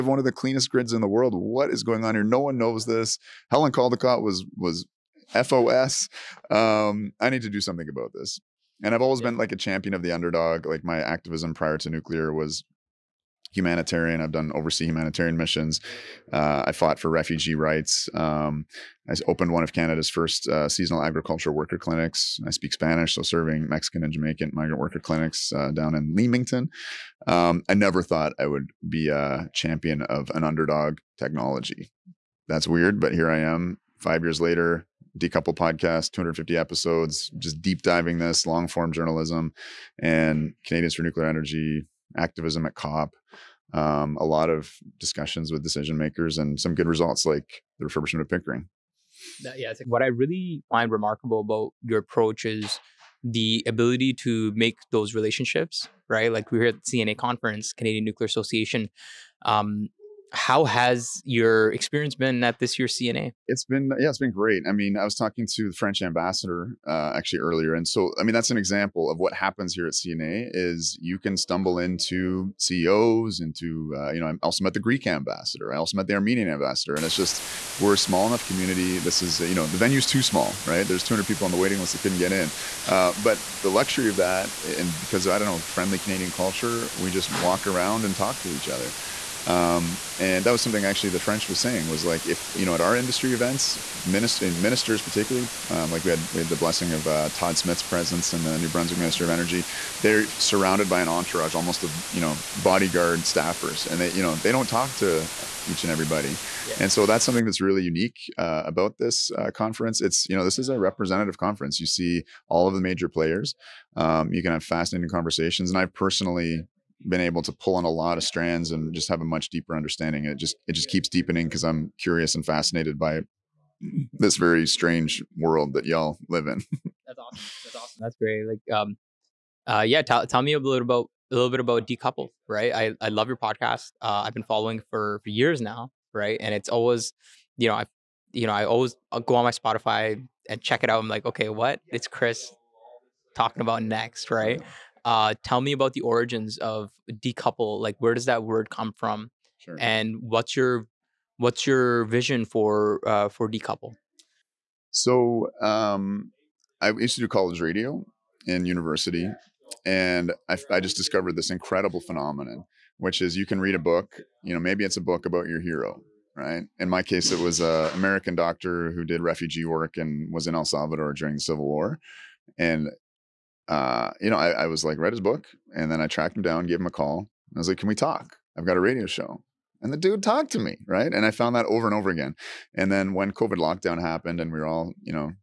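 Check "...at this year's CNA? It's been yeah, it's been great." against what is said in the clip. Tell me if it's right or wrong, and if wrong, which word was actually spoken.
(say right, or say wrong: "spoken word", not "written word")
right.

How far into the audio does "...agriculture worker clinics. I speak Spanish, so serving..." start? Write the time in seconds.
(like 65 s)
21 s.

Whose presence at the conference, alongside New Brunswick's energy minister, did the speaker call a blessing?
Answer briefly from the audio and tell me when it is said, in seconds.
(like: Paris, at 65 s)
Todd Smith, at 97 s.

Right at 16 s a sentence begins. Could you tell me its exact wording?
Uh, I fought for refugee rights.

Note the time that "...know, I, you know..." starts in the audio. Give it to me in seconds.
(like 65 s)
137 s.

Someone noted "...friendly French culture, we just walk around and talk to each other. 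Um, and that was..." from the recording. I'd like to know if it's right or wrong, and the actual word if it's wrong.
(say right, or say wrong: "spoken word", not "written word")
wrong: "Canadian", not "French".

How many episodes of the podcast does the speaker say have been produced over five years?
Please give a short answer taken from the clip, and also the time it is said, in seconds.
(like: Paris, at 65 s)
250, at 36 s.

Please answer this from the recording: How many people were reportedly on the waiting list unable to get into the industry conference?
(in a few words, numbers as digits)
200.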